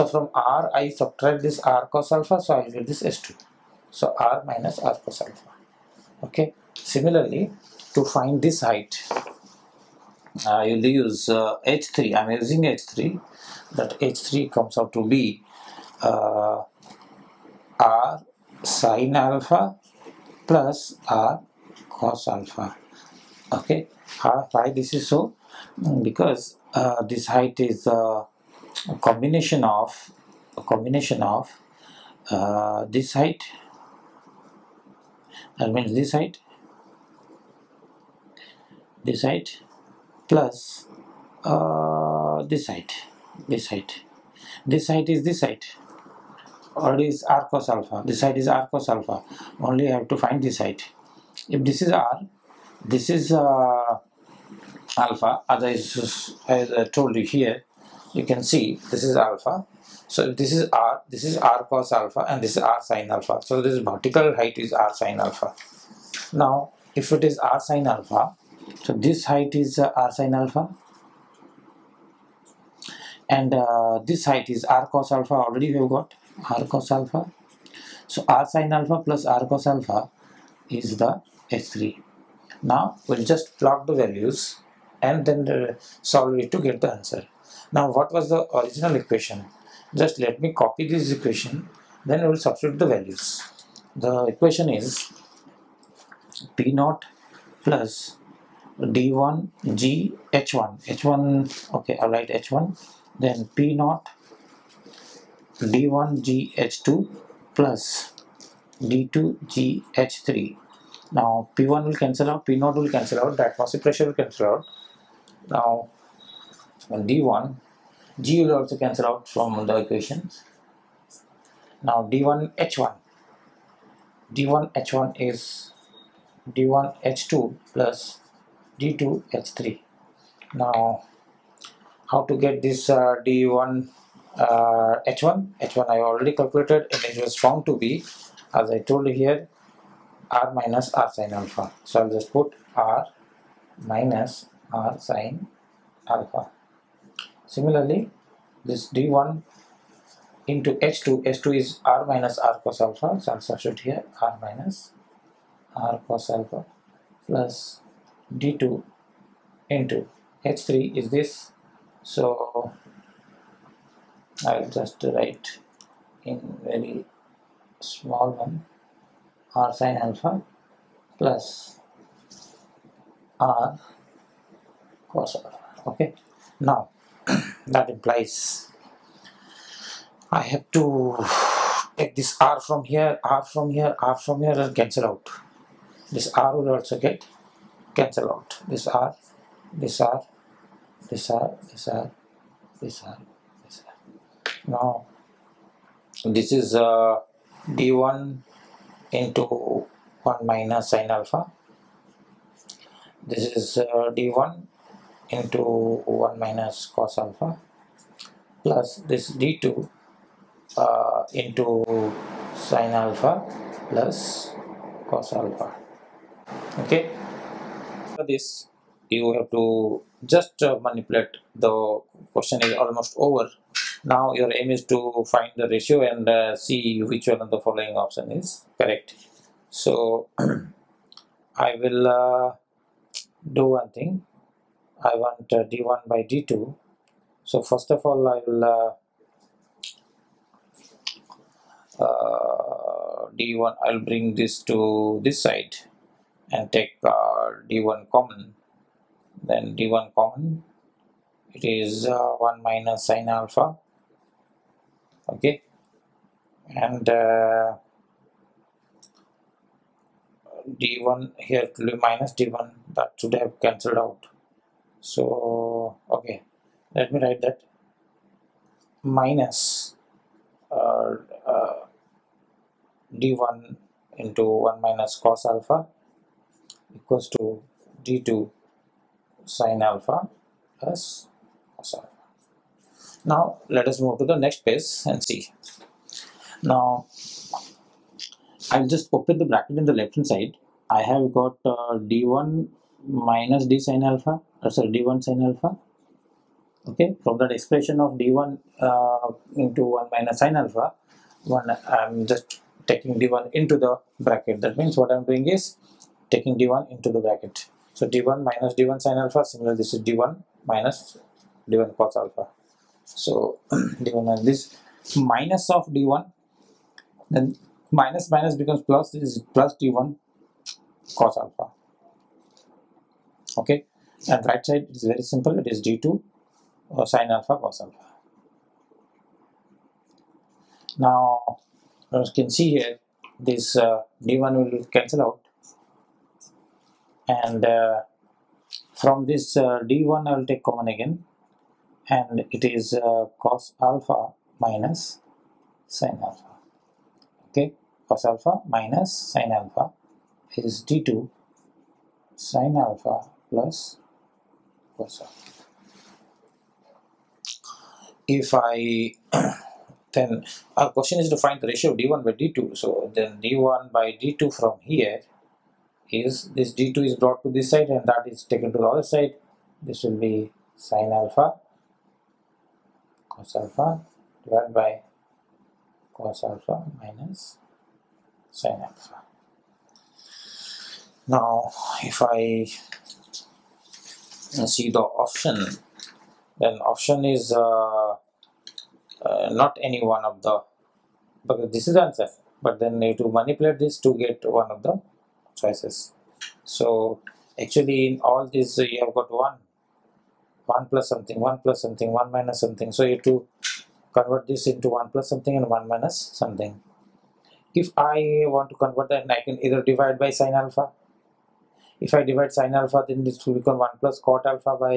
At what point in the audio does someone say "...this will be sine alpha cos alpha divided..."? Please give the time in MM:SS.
06:09.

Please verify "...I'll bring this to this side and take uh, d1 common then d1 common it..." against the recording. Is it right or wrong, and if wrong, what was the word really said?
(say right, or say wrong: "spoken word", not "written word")
right.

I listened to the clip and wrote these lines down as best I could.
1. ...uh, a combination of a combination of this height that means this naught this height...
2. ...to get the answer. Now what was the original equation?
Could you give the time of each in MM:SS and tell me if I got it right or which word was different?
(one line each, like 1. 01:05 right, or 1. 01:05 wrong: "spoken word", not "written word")
1. 00:27 wrong: "height", not "naught"
2. 01:26 right.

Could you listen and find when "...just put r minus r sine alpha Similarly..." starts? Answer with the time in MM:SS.
02:22.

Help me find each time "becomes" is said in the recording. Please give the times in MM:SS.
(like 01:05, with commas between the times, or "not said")
05:18, 06:53.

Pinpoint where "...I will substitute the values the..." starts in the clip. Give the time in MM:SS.
01:32.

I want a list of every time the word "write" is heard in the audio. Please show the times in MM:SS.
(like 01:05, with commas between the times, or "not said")
01:42, 02:45, 04:27.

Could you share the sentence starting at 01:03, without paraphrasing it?
So this vertical height is r sine alpha.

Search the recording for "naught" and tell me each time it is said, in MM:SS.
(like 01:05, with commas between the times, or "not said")
01:36, 01:43, 01:52.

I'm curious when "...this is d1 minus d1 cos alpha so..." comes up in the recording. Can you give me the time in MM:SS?
05:09.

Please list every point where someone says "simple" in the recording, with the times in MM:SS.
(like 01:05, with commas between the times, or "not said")
05:25.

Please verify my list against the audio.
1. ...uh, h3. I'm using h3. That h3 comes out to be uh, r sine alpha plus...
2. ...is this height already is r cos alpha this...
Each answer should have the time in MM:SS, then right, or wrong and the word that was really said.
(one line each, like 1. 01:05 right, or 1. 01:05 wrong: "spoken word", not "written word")
1. 00:11 right
2. 00:45 right.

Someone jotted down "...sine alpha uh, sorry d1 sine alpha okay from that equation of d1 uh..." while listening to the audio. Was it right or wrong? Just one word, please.
wrong.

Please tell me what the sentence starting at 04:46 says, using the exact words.
Now I'll just open the bracket in the left hand side.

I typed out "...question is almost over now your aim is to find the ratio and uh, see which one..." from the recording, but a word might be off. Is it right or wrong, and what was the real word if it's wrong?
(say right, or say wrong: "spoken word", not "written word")
right.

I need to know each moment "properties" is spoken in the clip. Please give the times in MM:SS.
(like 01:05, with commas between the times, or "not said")
not said.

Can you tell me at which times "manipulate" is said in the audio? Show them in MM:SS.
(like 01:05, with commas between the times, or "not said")
03:40, 06:33.